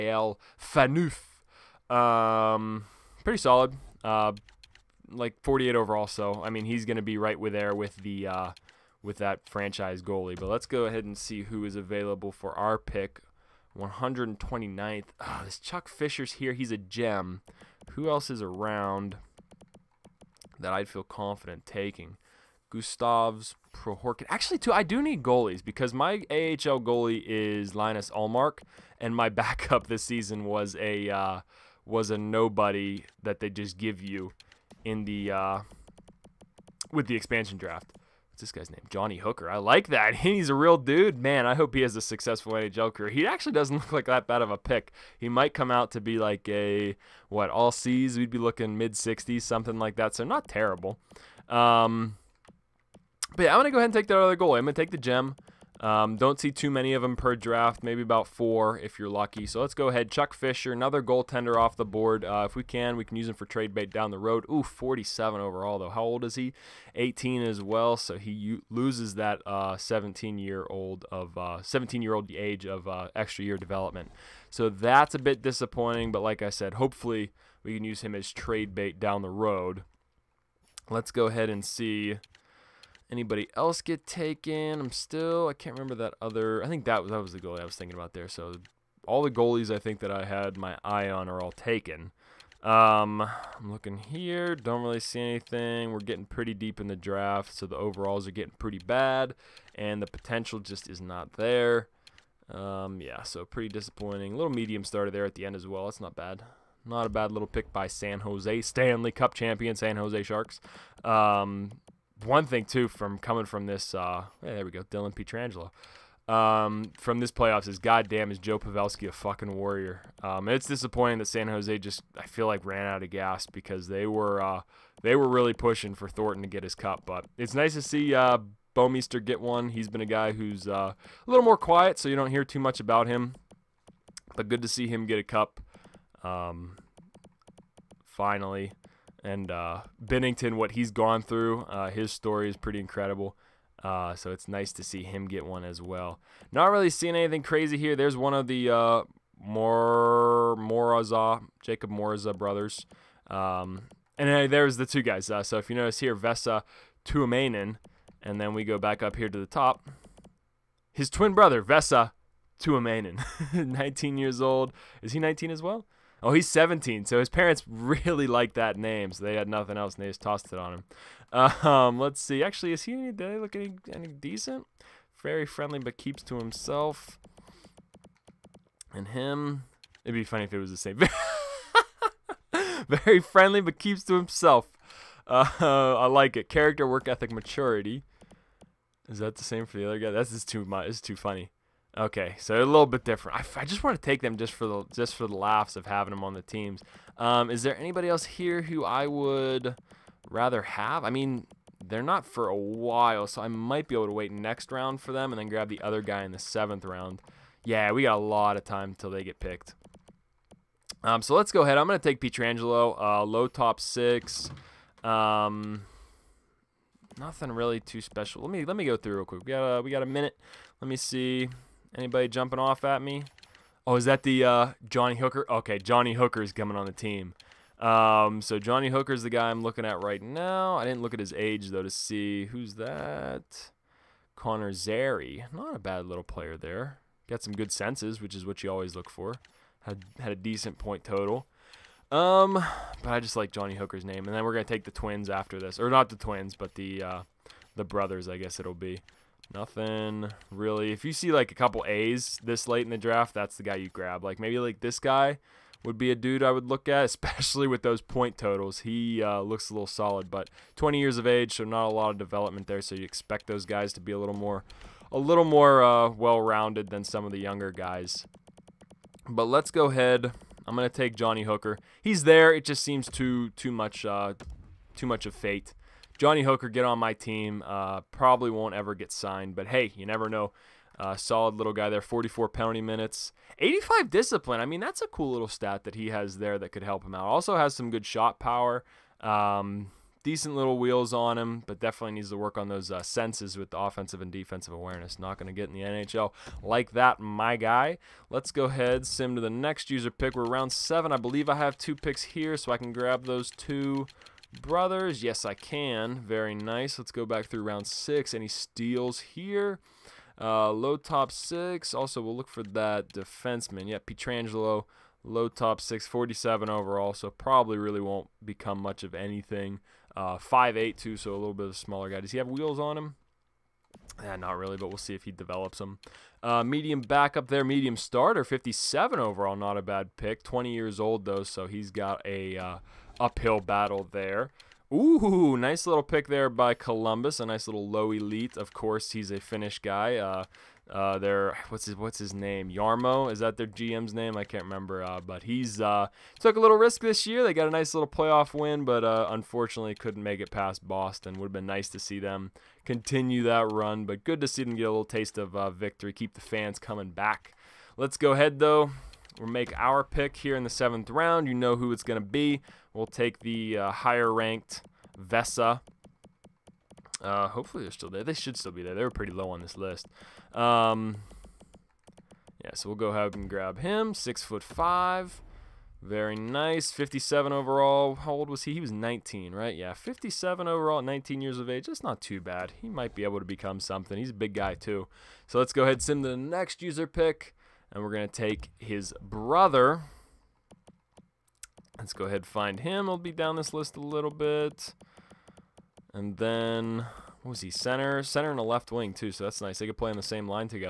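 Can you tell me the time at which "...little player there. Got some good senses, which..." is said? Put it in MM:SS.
03:56.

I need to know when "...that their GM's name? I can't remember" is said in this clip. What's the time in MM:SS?
05:43.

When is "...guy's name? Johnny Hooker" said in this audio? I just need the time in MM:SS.
00:38.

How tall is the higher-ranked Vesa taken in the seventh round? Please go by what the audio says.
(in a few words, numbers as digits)
6'5".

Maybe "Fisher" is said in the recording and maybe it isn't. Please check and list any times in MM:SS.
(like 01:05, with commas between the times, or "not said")
00:15, 01:00.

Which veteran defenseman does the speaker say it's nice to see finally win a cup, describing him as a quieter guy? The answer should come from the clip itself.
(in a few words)
Bouwmeester.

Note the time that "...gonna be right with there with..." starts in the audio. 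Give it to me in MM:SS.
00:06.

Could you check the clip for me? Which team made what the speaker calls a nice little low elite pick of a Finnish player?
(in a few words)
Columbus.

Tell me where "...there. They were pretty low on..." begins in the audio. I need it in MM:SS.
06:08.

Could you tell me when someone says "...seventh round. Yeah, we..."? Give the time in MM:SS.
03:26.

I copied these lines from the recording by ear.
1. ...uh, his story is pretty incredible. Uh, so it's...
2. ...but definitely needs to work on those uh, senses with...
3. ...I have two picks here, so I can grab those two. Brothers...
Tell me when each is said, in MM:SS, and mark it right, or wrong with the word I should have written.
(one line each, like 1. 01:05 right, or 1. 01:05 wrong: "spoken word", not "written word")
1. 02:21 right
2. 04:51 right
3. 05:01 right.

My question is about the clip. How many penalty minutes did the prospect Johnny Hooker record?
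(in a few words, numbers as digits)
44.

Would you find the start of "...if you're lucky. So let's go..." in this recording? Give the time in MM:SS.
00:58.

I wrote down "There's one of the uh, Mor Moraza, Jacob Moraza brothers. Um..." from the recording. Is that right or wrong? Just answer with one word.
right.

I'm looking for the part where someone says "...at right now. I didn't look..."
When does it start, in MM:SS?
03:49.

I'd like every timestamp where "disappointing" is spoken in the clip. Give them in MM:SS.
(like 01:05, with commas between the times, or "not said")
01:15, 01:43, 02:00.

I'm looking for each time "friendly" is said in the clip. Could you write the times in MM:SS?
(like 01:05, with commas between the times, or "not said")
02:55, 03:03.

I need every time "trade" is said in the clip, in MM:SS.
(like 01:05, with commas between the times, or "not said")
01:03, 01:18.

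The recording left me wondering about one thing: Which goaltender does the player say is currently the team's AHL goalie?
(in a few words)
Linus Ullmark.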